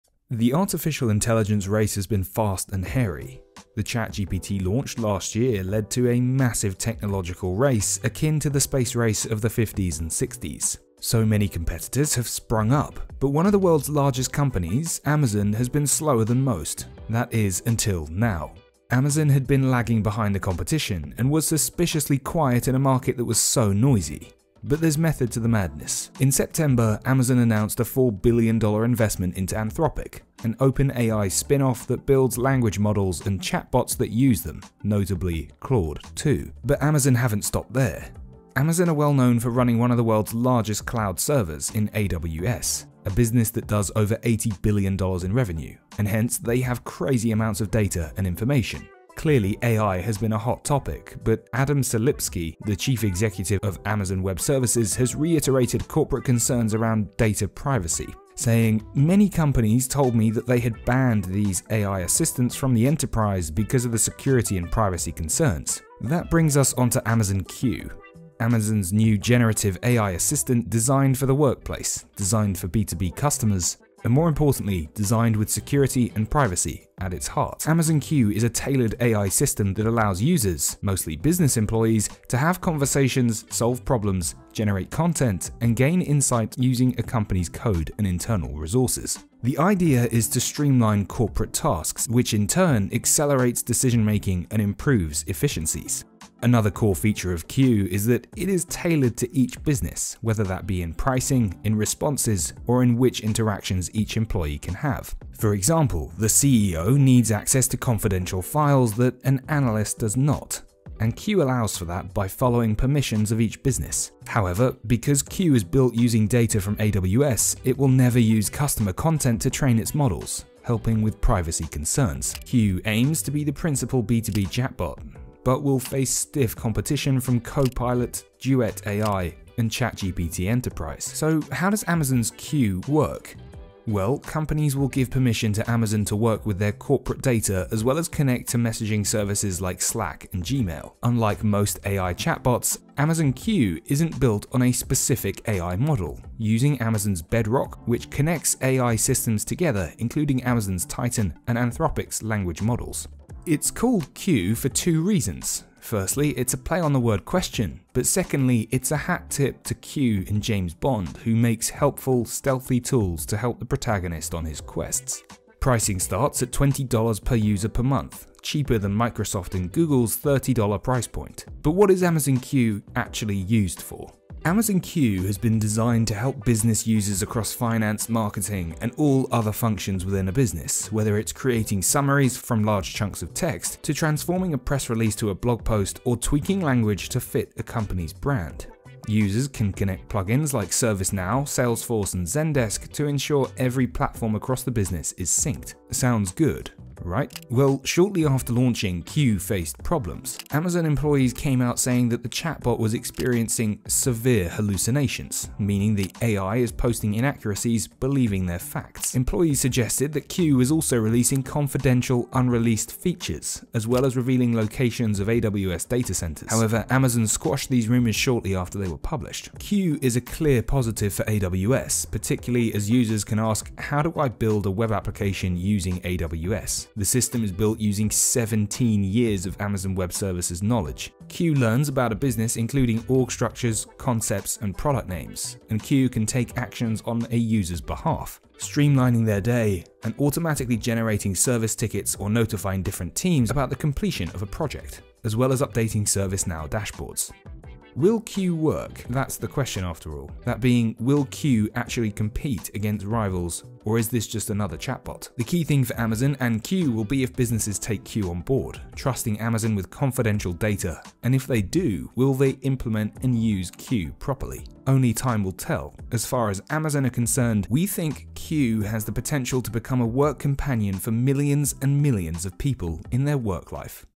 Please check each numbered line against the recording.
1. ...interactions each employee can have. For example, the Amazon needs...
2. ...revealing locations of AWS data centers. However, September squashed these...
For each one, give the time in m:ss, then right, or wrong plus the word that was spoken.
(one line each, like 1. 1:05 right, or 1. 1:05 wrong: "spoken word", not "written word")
1. 1:43 wrong: "CEO", not "Amazon"
2. 3:34 wrong: "Amazon", not "September".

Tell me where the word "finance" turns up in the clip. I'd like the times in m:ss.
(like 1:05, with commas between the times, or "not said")
2:57.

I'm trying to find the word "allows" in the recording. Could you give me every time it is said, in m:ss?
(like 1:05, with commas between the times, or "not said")
1:19, 1:51.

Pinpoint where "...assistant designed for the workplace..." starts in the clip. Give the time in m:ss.
1:10.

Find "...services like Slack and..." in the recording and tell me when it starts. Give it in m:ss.
2:19.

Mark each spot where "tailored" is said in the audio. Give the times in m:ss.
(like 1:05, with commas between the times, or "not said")
1:18, 1:38.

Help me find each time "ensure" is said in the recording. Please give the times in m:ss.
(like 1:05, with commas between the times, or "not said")
3:13.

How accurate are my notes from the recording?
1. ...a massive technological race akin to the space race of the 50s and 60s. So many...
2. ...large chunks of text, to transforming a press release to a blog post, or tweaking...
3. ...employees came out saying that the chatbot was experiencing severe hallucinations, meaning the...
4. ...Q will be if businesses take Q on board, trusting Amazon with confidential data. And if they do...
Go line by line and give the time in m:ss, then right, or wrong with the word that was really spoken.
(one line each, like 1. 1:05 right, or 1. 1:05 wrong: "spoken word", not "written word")
1. 0:06 right
2. 3:02 right
3. 3:20 right
4. 4:16 right.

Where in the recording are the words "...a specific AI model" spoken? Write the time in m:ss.
2:24.